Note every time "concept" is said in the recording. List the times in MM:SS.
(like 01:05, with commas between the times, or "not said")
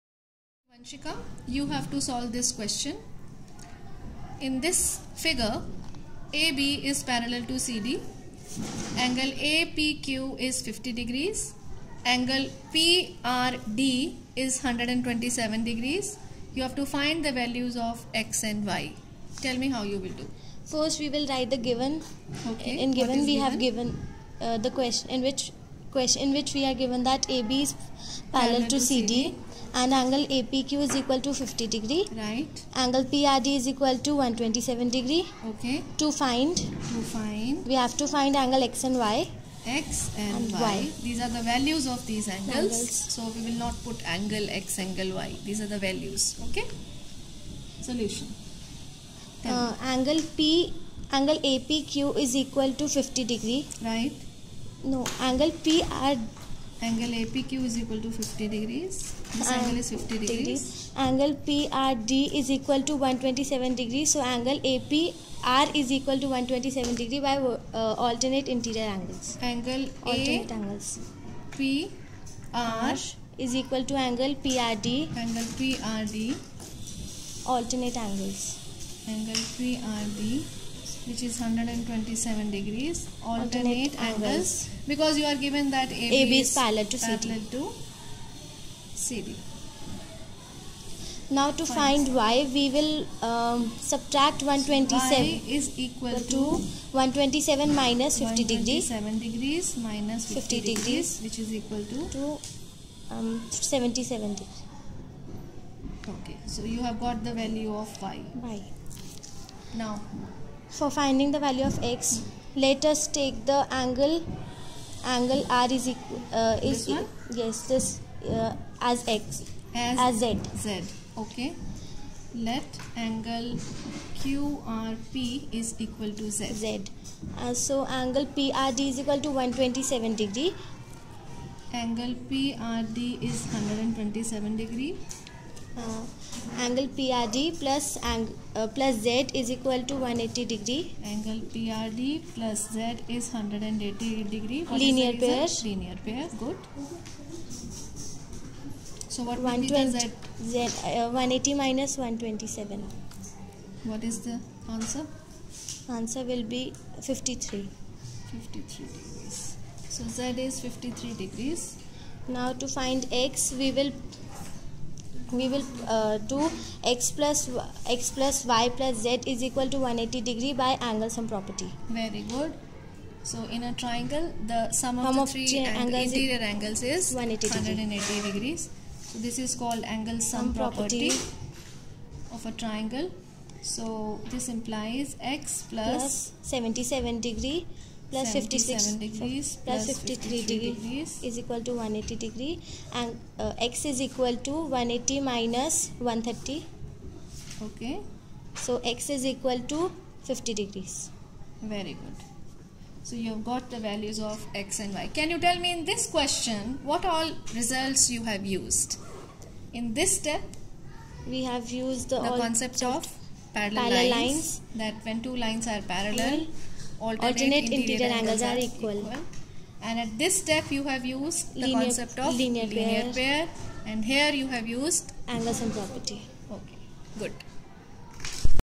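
03:32, 03:41.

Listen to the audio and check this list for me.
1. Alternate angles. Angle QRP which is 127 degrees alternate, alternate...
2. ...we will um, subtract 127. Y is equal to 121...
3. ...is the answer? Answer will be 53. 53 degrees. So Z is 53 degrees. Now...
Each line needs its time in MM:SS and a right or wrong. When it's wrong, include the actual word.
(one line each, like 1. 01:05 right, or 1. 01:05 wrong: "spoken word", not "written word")
1. 01:17 wrong: "PRD", not "QRP"
2. 01:32 wrong: "127", not "121"
3. 02:34 right.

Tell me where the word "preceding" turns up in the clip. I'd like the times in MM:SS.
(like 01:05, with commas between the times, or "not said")
not said.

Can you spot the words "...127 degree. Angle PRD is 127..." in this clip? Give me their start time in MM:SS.
02:09.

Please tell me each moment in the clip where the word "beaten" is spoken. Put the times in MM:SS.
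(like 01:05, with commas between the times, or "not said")
not said.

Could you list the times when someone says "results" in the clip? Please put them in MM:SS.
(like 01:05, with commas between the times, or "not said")
03:27.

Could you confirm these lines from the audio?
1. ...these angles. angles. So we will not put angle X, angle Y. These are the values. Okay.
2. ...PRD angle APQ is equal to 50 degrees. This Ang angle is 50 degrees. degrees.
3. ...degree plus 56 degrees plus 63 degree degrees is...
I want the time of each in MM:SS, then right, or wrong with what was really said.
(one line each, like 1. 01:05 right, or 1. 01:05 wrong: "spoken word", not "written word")
1. 00:42 right
2. 00:55 right
3. 03:07 wrong: "53", not "63".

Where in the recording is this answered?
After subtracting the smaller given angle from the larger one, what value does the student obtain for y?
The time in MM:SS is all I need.
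01:43.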